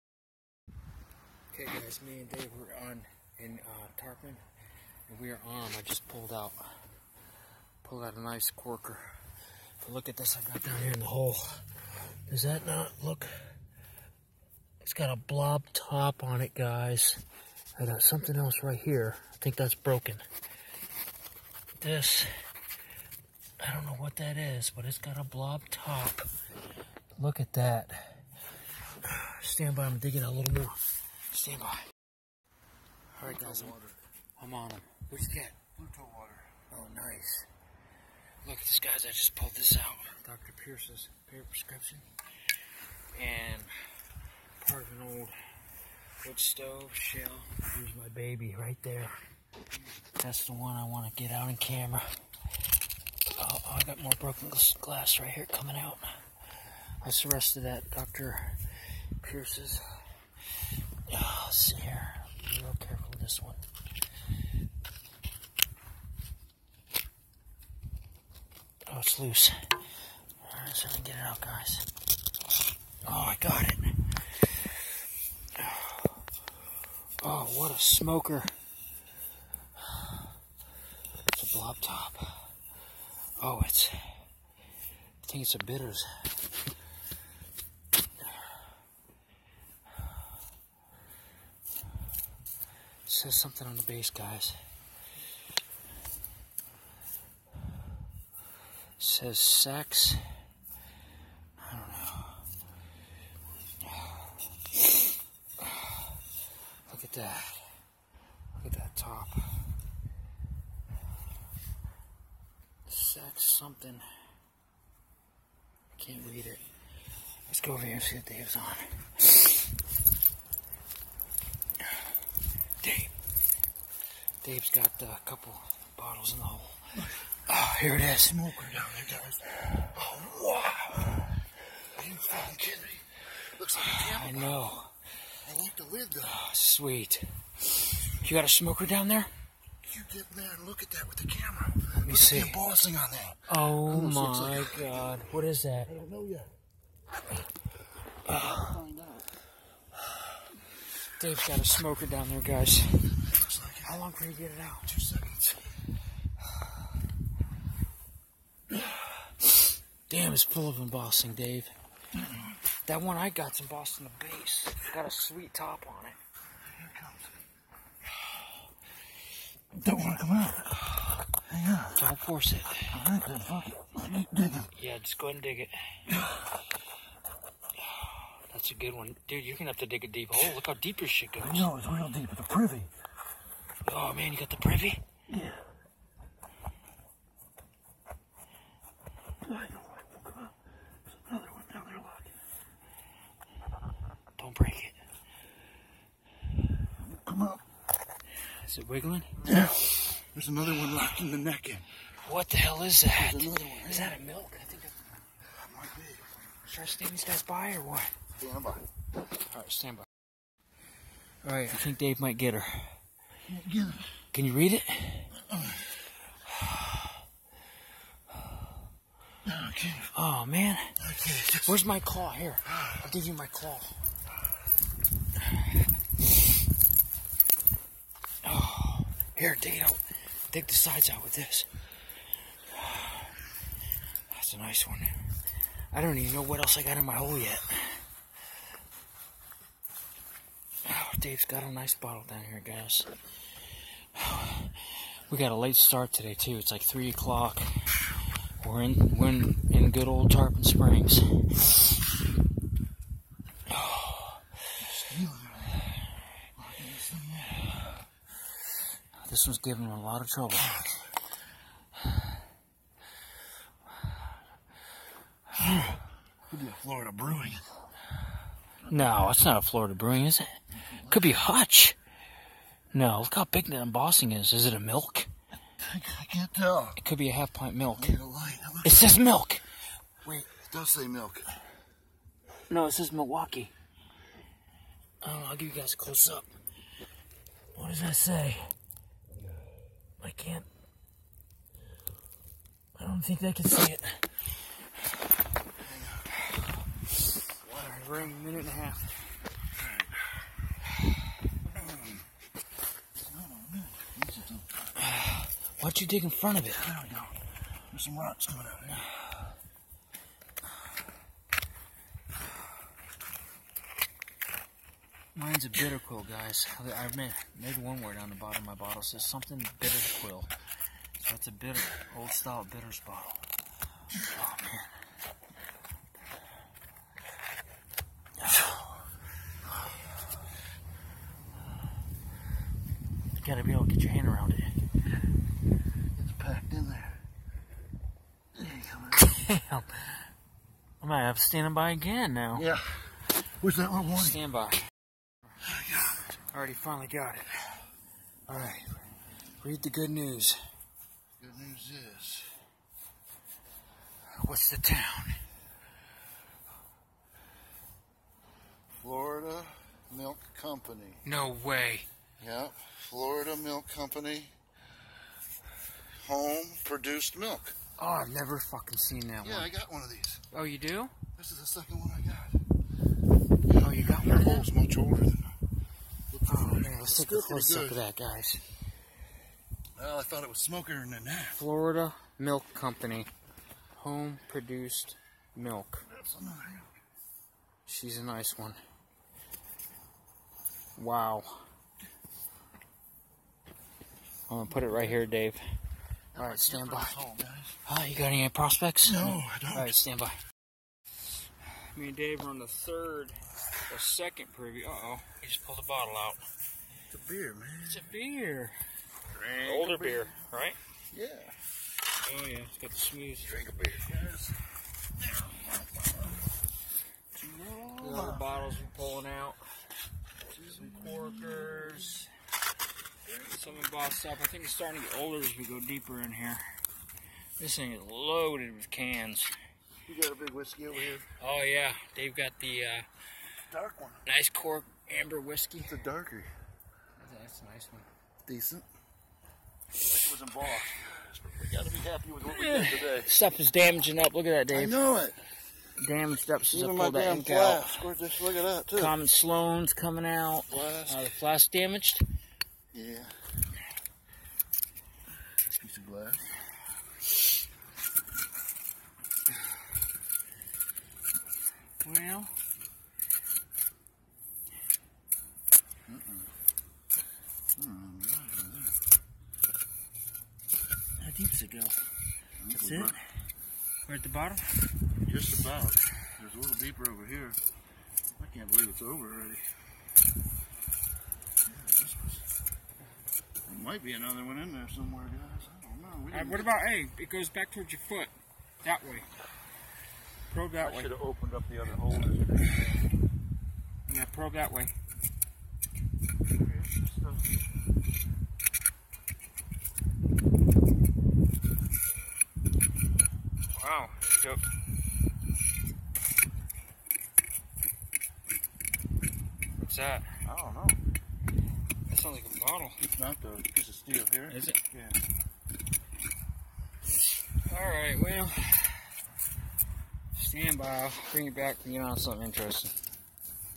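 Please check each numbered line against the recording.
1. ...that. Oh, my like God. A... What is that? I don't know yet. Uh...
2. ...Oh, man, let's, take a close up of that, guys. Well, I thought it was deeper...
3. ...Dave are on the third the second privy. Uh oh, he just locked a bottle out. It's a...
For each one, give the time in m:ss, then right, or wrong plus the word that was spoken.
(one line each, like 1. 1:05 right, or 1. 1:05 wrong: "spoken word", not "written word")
1. 2:23 right
2. 6:16 wrong: "smoker", not "deeper"
3. 6:42 wrong: "pulled", not "locked".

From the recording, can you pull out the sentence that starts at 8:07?
It goes back towards your foot.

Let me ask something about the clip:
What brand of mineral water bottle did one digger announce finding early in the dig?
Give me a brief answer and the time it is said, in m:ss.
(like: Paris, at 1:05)
Pluto water, at 0:35.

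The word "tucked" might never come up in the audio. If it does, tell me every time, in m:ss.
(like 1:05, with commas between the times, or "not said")
not said.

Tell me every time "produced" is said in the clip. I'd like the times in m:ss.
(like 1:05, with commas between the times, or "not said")
6:06, 6:24.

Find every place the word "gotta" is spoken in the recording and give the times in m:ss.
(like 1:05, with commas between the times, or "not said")
5:33, 7:21.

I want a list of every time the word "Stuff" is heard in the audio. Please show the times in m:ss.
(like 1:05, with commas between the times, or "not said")
7:23.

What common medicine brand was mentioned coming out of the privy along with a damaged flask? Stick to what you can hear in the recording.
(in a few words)
Sloan's.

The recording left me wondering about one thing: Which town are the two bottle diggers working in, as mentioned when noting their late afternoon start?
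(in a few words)
Tarpon Springs.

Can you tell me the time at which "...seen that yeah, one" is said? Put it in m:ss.
6:08.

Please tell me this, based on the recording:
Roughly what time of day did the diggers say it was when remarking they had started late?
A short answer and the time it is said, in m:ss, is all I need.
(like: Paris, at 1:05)
3 o'clock, at 4:06.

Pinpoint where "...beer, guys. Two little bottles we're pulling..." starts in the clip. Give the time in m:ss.
6:53.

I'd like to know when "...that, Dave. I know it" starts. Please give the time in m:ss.
7:24.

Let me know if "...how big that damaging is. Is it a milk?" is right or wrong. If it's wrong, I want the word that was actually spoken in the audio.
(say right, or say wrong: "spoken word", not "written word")
wrong: "embossing", not "damaging".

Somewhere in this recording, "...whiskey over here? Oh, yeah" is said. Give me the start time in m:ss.
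7:10.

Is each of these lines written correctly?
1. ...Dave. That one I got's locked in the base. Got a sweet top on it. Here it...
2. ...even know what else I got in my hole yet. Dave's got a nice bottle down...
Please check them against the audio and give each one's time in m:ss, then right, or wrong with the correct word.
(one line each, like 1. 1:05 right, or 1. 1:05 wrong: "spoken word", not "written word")
1. 2:41 wrong: "embossed", not "locked"
2. 3:56 right.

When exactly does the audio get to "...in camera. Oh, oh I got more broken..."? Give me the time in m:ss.
0:51.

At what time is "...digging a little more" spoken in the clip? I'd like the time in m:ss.
0:29.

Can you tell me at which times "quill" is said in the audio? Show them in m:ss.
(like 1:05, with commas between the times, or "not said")
5:15, 5:20.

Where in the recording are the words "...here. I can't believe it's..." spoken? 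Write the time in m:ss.
7:57.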